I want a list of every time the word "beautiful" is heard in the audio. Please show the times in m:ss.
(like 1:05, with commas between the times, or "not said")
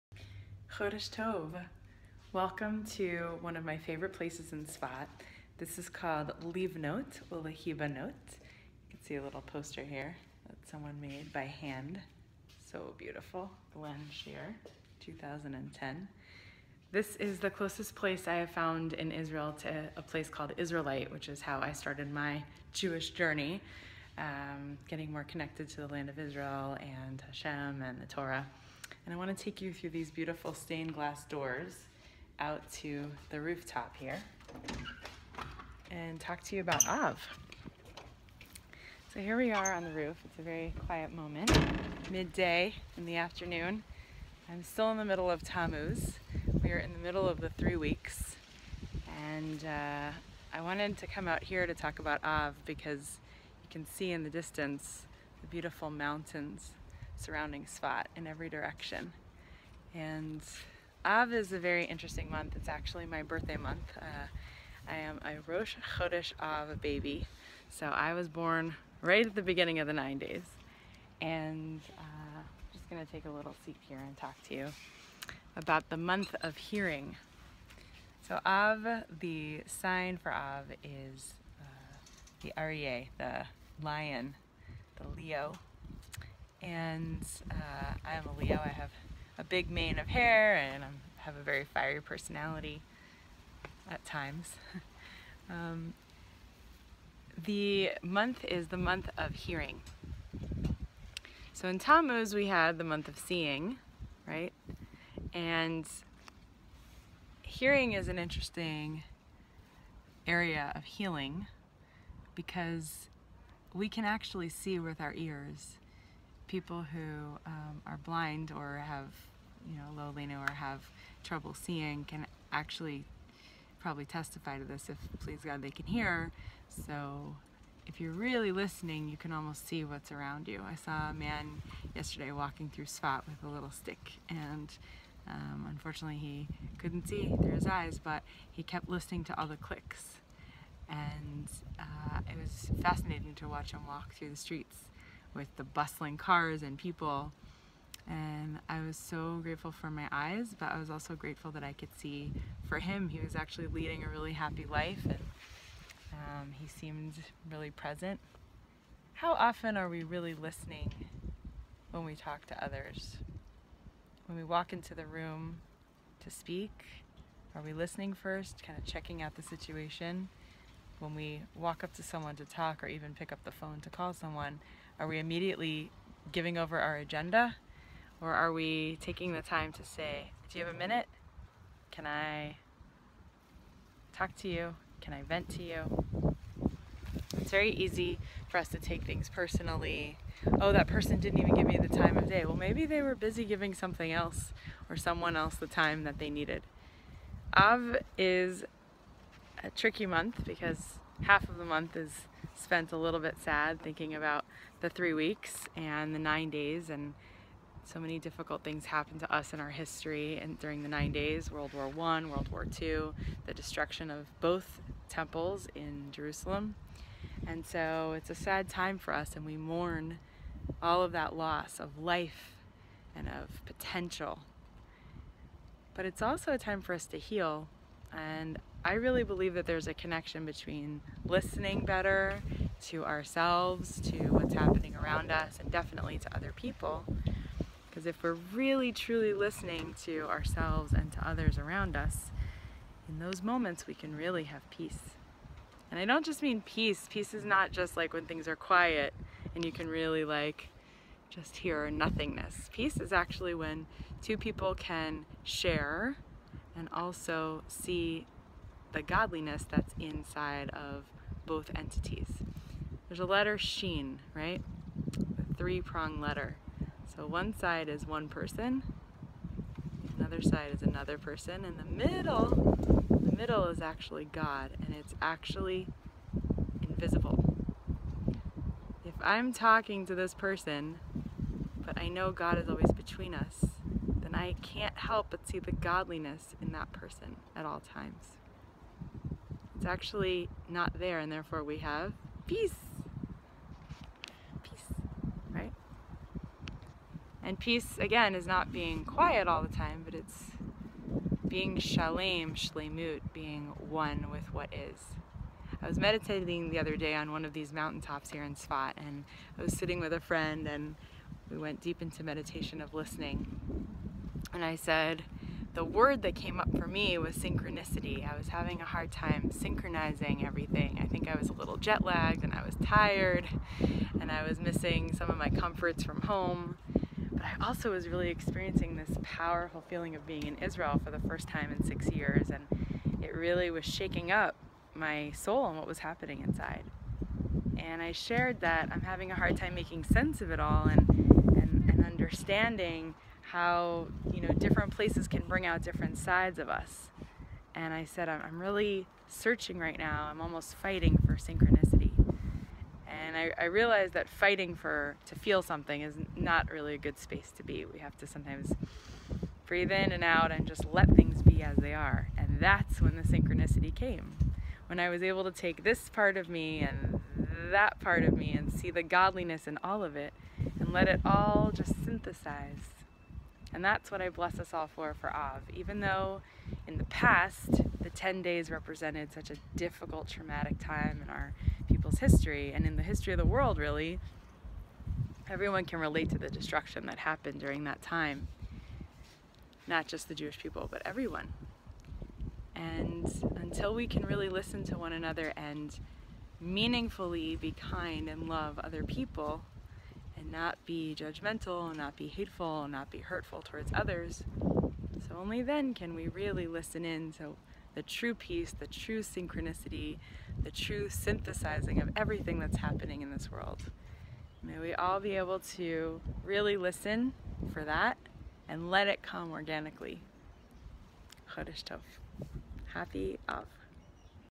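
0:12, 0:30, 0:55.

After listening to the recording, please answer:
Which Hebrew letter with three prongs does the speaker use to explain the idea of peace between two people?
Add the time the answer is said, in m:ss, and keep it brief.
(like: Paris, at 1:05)
Sheen, at 4:23.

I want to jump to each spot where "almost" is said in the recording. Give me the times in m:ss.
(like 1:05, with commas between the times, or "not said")
2:09, 5:50.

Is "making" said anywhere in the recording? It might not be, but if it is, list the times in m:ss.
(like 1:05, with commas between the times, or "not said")
5:39.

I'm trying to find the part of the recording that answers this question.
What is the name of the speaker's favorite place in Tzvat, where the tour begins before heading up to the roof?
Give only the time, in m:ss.
0:06.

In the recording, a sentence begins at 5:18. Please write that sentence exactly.
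I was having a hard time synchronizing everything.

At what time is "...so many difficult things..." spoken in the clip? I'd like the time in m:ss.
3:27.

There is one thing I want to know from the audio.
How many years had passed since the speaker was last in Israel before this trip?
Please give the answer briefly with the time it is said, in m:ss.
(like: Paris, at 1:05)
6 years, at 5:31.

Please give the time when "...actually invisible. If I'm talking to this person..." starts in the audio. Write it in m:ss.
4:35.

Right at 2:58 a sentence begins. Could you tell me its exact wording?
Or are we taking the time to say, Do you have a minute?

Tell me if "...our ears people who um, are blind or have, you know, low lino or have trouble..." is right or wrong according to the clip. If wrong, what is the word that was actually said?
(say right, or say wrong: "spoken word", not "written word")
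right.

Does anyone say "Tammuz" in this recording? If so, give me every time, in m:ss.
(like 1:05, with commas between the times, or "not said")
0:45, 1:41.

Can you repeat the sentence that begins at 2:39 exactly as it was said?
How often are we really listening when we talk to others?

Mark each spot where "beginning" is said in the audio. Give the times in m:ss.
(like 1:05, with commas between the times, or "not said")
1:09.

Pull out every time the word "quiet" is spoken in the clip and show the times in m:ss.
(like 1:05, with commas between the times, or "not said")
0:40, 4:08, 4:59.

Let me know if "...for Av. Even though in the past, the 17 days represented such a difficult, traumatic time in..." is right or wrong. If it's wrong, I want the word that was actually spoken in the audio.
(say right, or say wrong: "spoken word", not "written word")
wrong: "10", not "17".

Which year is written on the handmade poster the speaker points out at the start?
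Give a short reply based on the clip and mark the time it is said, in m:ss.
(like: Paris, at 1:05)
2010, at 0:15.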